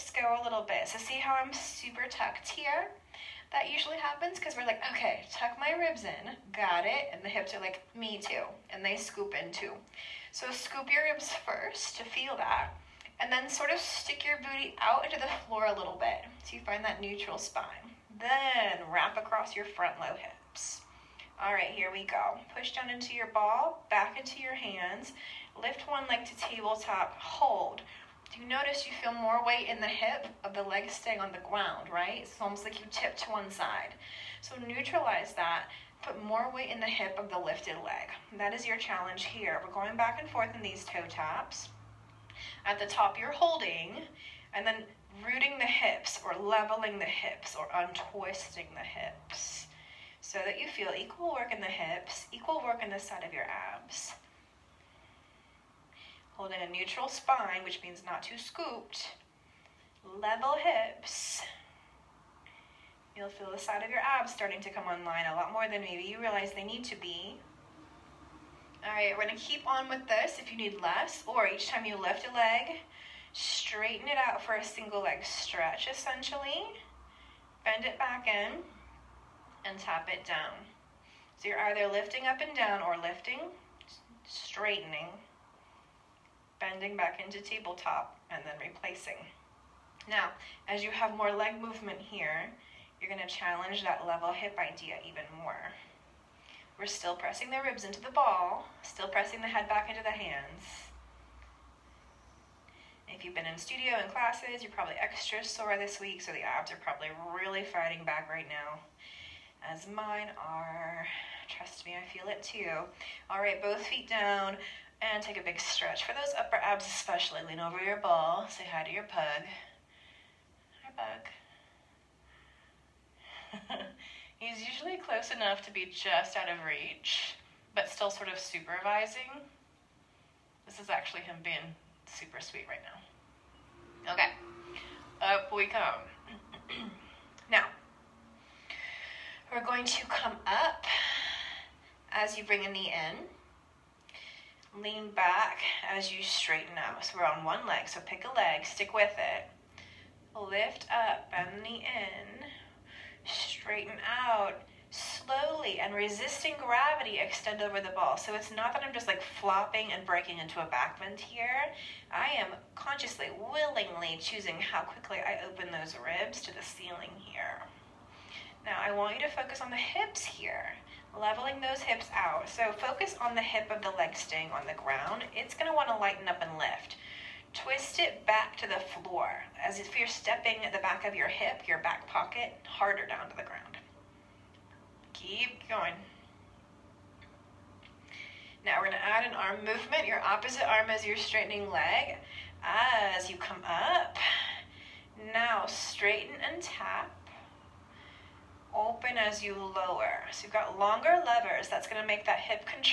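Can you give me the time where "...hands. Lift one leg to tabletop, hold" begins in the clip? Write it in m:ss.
0:24.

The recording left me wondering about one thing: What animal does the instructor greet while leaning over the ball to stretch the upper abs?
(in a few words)
Pug.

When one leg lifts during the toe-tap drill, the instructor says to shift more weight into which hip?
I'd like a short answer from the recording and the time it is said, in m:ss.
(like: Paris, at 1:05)
The hip of the lifted leg, at 0:36.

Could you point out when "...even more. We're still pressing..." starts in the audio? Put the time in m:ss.
1:35.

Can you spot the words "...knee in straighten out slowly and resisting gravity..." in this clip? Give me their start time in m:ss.
2:31.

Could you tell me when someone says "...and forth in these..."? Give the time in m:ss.
0:40.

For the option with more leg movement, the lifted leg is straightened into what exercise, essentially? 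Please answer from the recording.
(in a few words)
Single leg stretch.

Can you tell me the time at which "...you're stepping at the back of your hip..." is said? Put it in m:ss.
2:59.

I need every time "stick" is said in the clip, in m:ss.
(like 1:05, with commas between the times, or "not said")
0:13, 2:28.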